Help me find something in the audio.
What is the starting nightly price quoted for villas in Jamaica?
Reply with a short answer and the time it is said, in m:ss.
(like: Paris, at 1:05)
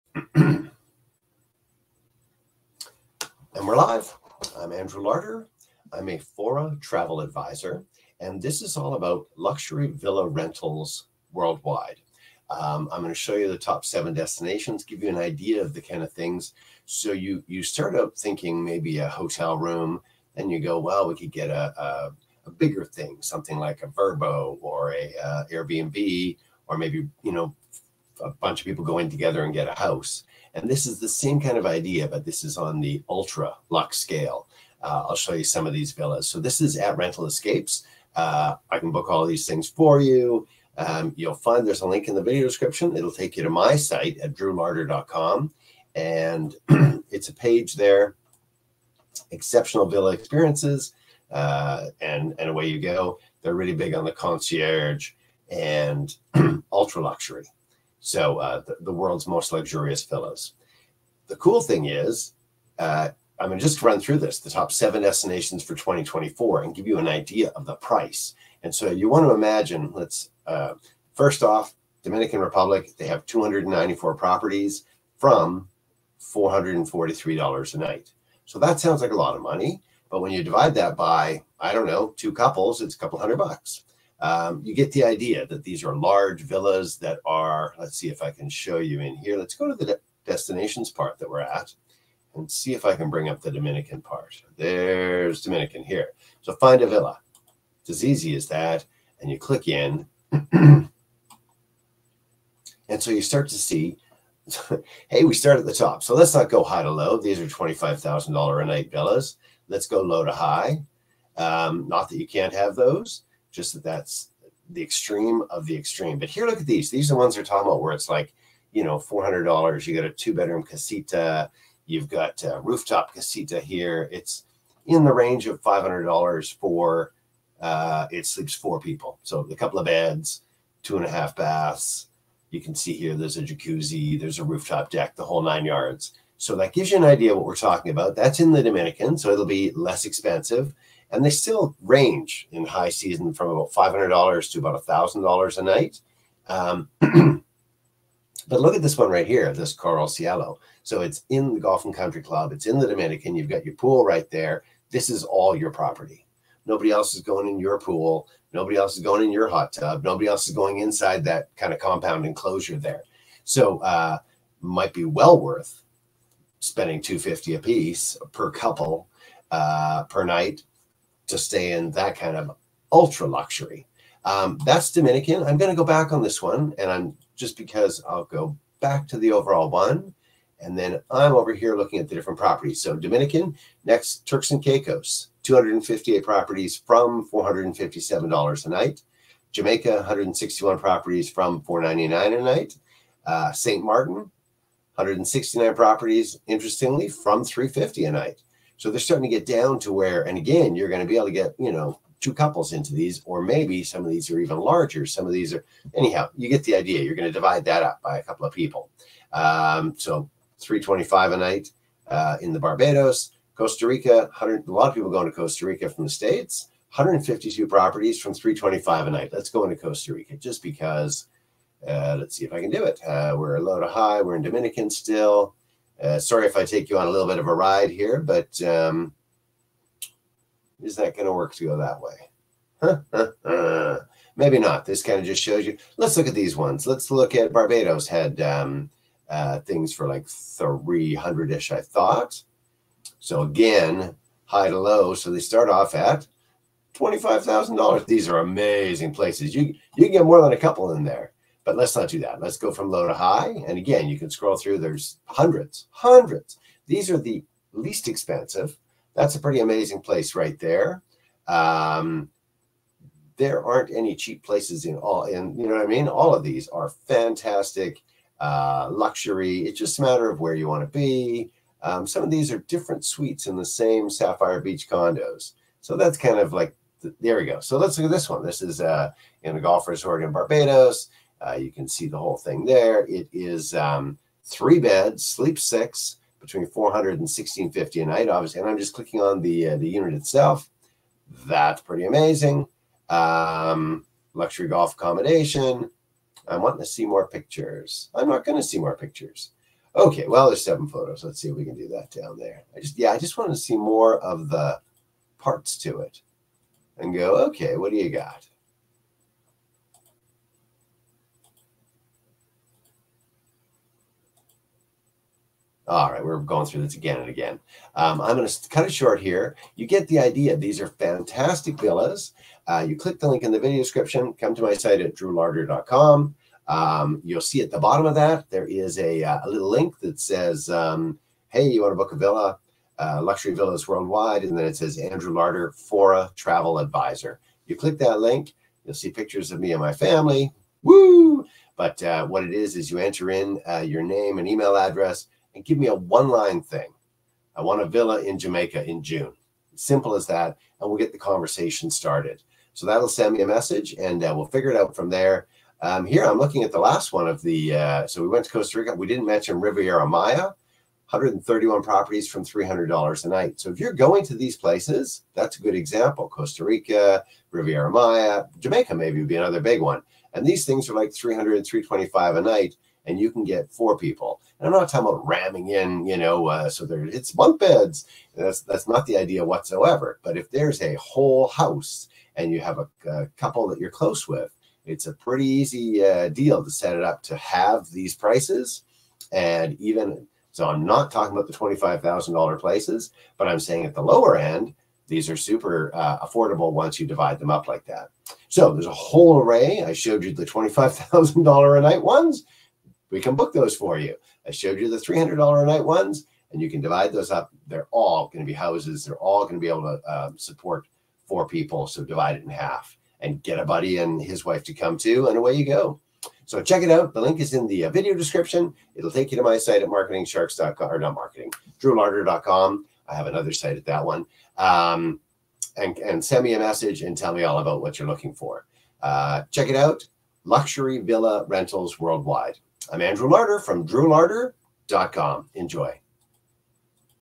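$499, at 3:11.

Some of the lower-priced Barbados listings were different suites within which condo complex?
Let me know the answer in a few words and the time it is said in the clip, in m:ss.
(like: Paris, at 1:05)
Sapphire Beach, at 4:34.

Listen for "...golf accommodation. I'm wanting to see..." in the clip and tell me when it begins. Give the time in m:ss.
4:54.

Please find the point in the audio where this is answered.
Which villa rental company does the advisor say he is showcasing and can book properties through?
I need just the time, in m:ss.
0:36.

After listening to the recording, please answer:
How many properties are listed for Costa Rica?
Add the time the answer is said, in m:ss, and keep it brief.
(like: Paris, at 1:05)
152, at 3:36.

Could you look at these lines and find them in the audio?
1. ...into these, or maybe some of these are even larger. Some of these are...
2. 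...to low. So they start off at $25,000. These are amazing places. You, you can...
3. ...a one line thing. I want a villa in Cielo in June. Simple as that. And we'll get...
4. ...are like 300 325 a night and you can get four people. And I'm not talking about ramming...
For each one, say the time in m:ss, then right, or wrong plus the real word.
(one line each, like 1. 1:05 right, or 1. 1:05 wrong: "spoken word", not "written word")
1. 3:22 right
2. 4:04 right
3. 5:45 wrong: "Jamaica", not "Cielo"
4. 6:10 right.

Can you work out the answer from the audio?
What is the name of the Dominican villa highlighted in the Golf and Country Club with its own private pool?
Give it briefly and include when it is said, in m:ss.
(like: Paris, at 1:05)
Coral Cielo, at 2:29.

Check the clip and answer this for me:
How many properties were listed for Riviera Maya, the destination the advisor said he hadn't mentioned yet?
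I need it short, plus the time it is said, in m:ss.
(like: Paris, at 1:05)
131, at 6:01.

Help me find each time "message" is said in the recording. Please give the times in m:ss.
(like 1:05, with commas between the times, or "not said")
5:53, 7:06.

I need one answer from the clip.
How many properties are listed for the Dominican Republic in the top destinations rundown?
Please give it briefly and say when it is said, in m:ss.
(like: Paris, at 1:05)
294, at 1:13.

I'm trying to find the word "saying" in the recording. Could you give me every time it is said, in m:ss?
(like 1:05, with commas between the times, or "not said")
6:33.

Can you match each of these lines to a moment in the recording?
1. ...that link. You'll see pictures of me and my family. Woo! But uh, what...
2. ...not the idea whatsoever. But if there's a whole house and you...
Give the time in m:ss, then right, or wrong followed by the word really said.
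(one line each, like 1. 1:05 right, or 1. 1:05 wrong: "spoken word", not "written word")
1. 5:37 right
2. 6:18 right.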